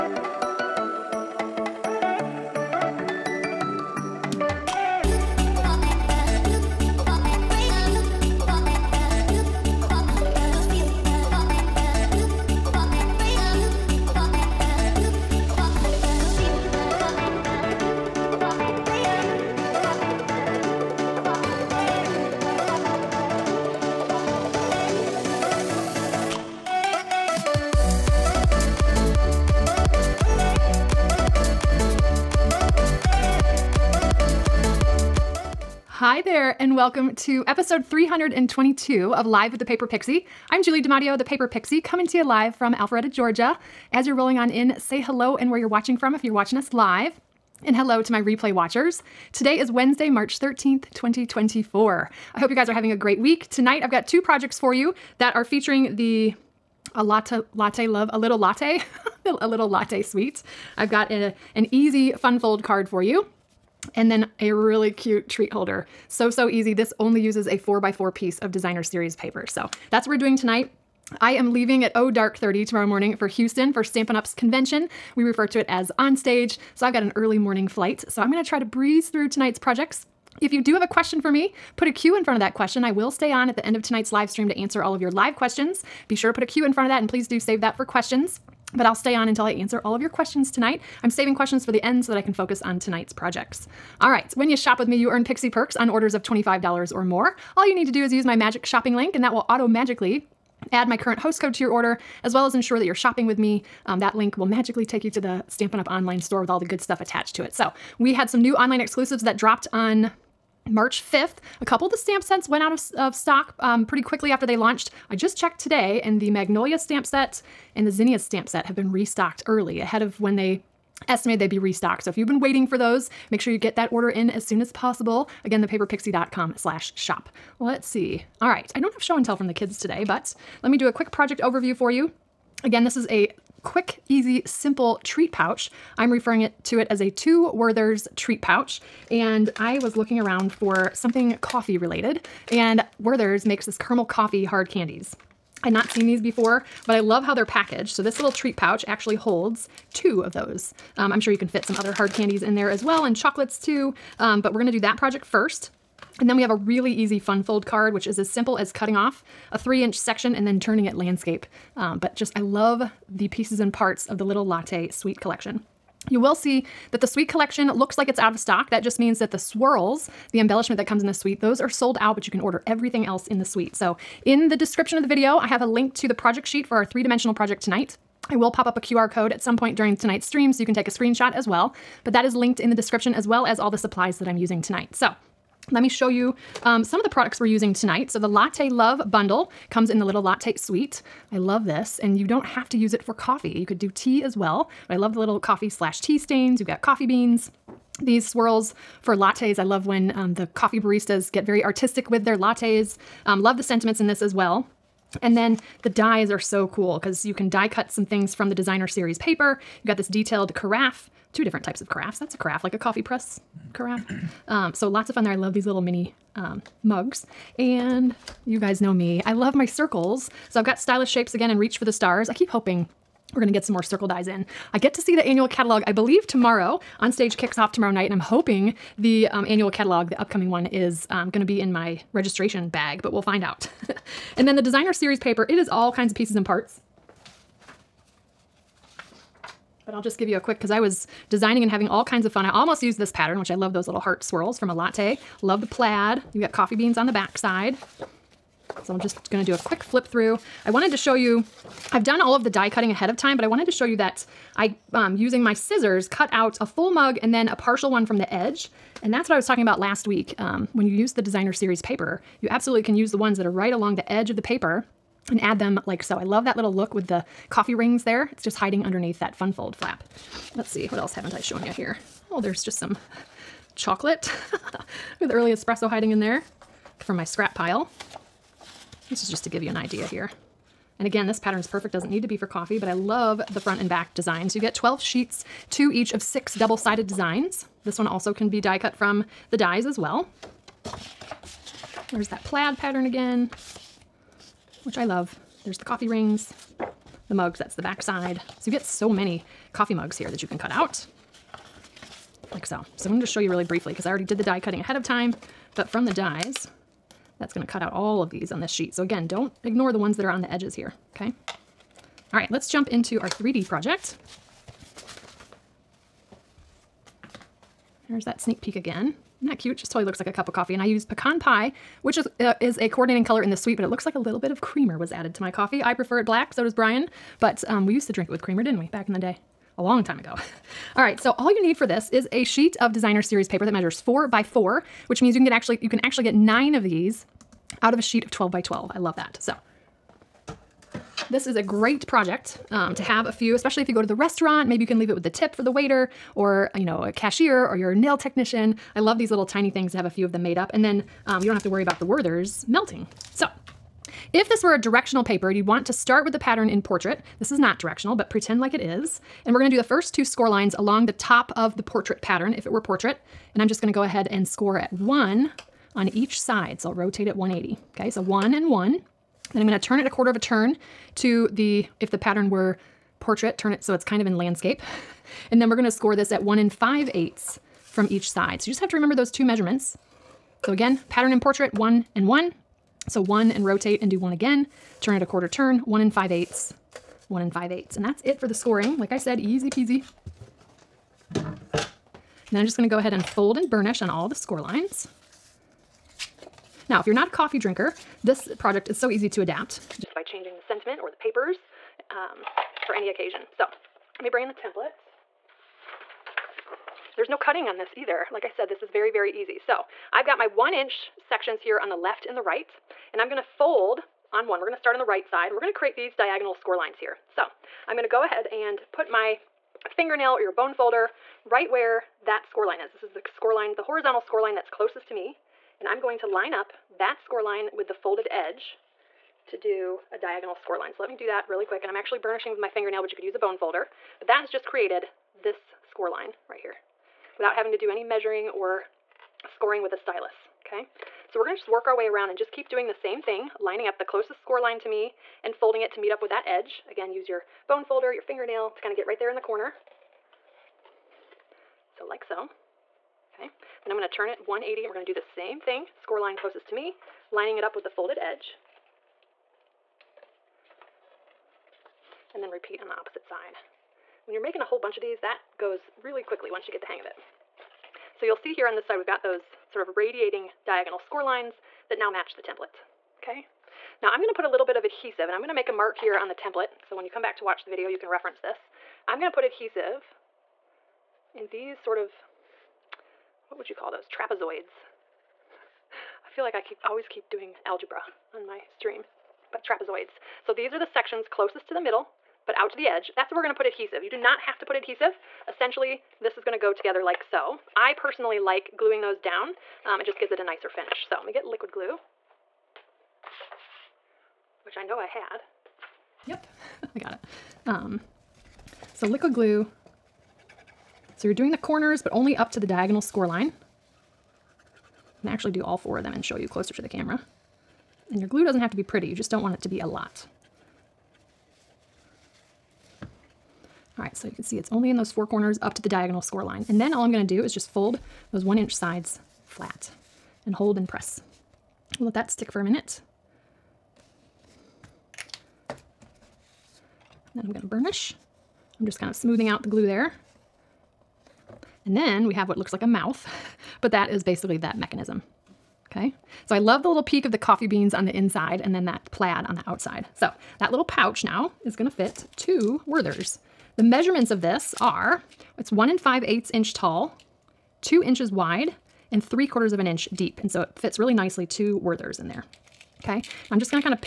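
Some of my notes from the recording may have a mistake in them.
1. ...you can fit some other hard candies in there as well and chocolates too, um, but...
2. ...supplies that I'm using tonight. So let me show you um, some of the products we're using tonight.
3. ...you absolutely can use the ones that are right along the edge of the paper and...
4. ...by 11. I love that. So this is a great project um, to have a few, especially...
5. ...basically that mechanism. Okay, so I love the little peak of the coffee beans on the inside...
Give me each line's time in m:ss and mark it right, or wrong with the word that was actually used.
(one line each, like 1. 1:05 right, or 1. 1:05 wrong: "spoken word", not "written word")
1. 2:31 right
2. 3:03 right
3. 4:22 right
4. 5:38 wrong: "12", not "11"
5. 9:04 right.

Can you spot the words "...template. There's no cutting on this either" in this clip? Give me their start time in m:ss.
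6:44.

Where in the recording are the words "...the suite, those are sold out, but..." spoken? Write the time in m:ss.
2:51.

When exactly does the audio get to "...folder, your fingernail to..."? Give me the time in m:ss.
7:27.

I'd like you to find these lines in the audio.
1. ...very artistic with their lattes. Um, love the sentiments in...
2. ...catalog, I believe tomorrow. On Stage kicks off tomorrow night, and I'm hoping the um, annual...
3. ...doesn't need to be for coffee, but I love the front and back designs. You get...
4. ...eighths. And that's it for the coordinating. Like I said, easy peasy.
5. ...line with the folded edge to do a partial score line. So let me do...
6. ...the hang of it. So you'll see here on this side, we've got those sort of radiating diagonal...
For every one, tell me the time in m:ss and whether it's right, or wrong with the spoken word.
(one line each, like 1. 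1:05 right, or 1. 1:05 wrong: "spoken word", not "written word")
1. 3:21 right
2. 3:45 right
3. 4:41 right
4. 6:27 wrong: "scoring", not "coordinating"
5. 7:07 wrong: "diagonal", not "partial"
6. 7:46 right.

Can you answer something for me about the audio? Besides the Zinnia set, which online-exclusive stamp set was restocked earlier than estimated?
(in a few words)
Magnolia.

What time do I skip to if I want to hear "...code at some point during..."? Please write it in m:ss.
2:59.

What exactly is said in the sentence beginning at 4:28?
It's just hiding underneath that fun fold flap.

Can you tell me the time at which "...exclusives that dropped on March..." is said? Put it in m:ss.
1:48.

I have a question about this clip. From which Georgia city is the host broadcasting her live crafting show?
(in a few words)
Alpharetta.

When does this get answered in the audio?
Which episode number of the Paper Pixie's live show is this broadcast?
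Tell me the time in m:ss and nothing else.
0:37.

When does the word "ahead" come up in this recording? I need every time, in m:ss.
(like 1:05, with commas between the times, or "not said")
1:59, 4:12, 5:04, 6:04, 6:32, 6:58.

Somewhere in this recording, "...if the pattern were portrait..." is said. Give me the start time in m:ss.
6:11.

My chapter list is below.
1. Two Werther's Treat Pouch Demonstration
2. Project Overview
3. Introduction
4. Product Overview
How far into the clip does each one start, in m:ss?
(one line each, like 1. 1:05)
1. 5:18
2. 2:12
3. 0:35
4. 3:07.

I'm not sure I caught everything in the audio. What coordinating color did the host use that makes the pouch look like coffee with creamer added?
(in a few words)
pecan pie.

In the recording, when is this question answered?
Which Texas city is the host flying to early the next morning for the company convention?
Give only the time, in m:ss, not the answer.
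1:13.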